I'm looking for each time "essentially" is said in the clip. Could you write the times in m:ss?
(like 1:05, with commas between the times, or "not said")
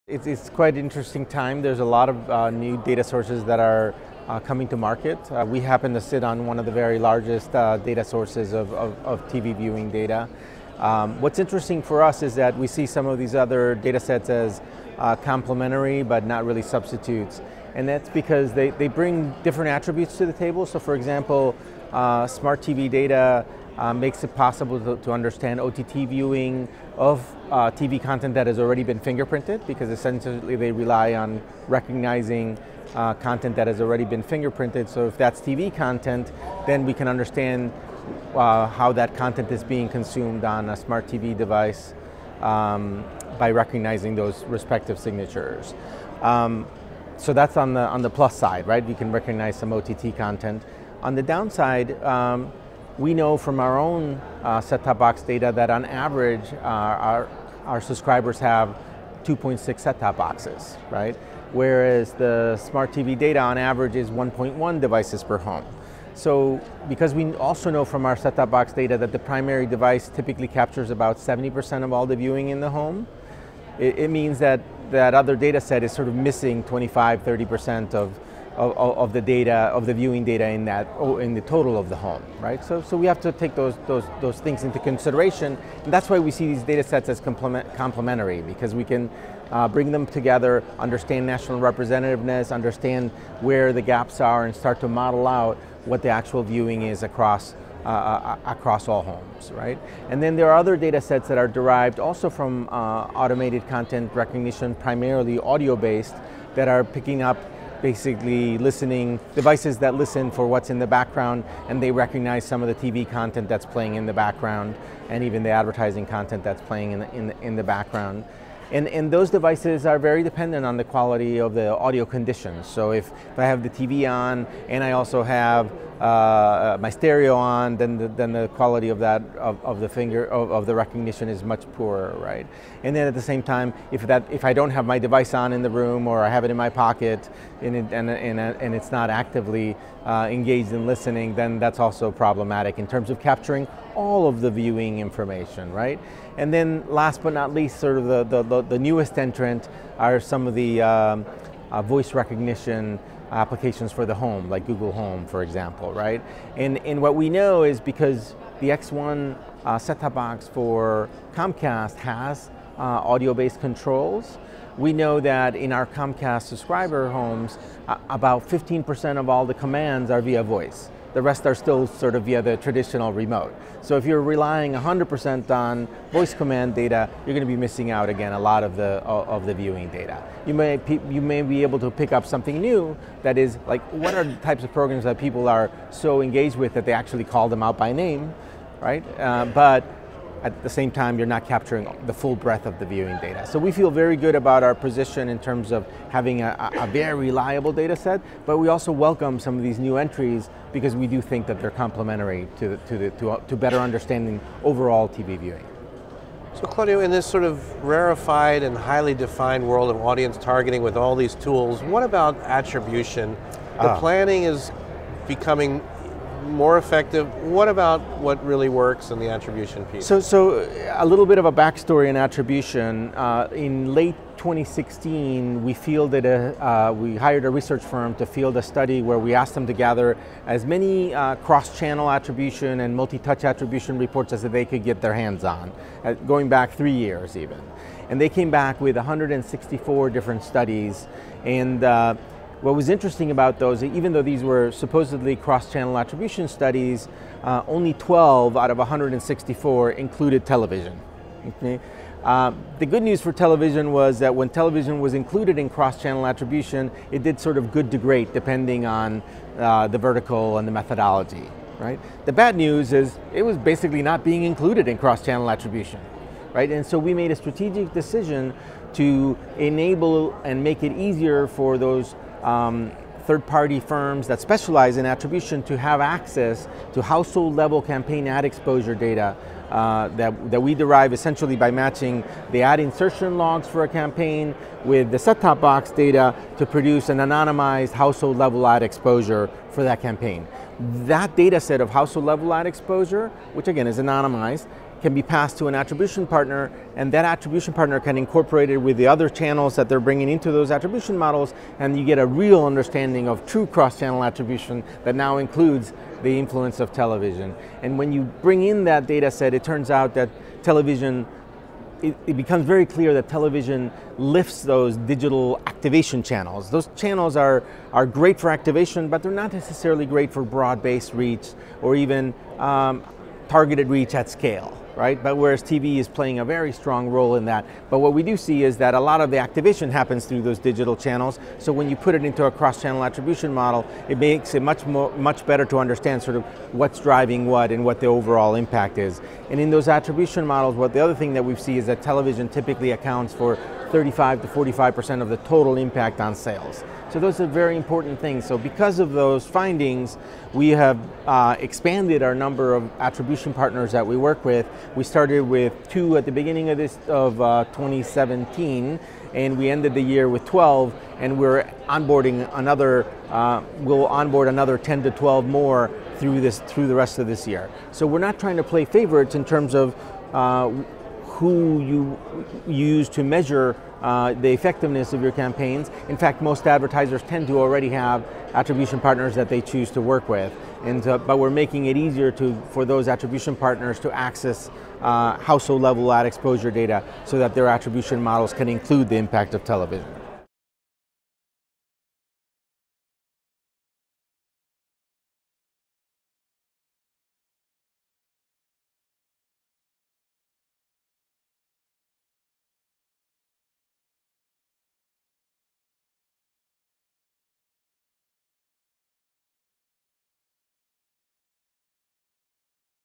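0:29, 4:41.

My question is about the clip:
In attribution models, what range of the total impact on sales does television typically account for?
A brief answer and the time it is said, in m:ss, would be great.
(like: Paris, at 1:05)
35 to 45%, at 5:43.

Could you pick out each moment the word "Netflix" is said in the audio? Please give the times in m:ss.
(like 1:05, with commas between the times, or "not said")
not said.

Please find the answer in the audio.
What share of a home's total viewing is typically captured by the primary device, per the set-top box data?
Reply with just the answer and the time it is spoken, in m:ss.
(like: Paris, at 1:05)
70%, at 1:11.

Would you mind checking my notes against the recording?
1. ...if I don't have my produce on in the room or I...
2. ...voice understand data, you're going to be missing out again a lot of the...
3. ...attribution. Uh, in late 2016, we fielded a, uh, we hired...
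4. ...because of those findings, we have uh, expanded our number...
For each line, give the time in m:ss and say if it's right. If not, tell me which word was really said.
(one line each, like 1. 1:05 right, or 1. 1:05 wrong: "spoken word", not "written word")
1. 2:14 wrong: "device", not "produce"
2. 2:56 wrong: "command", not "understand"
3. 3:42 right
4. 5:48 right.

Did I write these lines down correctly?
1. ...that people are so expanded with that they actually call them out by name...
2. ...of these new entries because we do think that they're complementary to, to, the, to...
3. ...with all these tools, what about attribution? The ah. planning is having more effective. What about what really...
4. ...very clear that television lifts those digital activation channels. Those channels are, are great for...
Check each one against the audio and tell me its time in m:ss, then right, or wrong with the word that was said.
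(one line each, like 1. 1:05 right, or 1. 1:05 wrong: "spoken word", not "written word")
1. 3:05 wrong: "engaged", not "expanded"
2. 3:19 right
3. 3:30 wrong: "becoming", not "having"
4. 5:12 right.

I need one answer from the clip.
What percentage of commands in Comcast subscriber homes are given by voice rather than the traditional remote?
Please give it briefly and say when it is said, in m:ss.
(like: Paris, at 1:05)
15%, at 2:48.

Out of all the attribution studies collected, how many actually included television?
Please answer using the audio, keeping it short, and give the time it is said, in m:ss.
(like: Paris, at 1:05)
12 out of 164, at 4:07.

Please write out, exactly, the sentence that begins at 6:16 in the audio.
In fact, most advertisers tend to already have attribution partners that they choose to work with.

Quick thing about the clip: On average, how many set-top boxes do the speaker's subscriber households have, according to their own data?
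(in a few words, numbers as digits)
2.6.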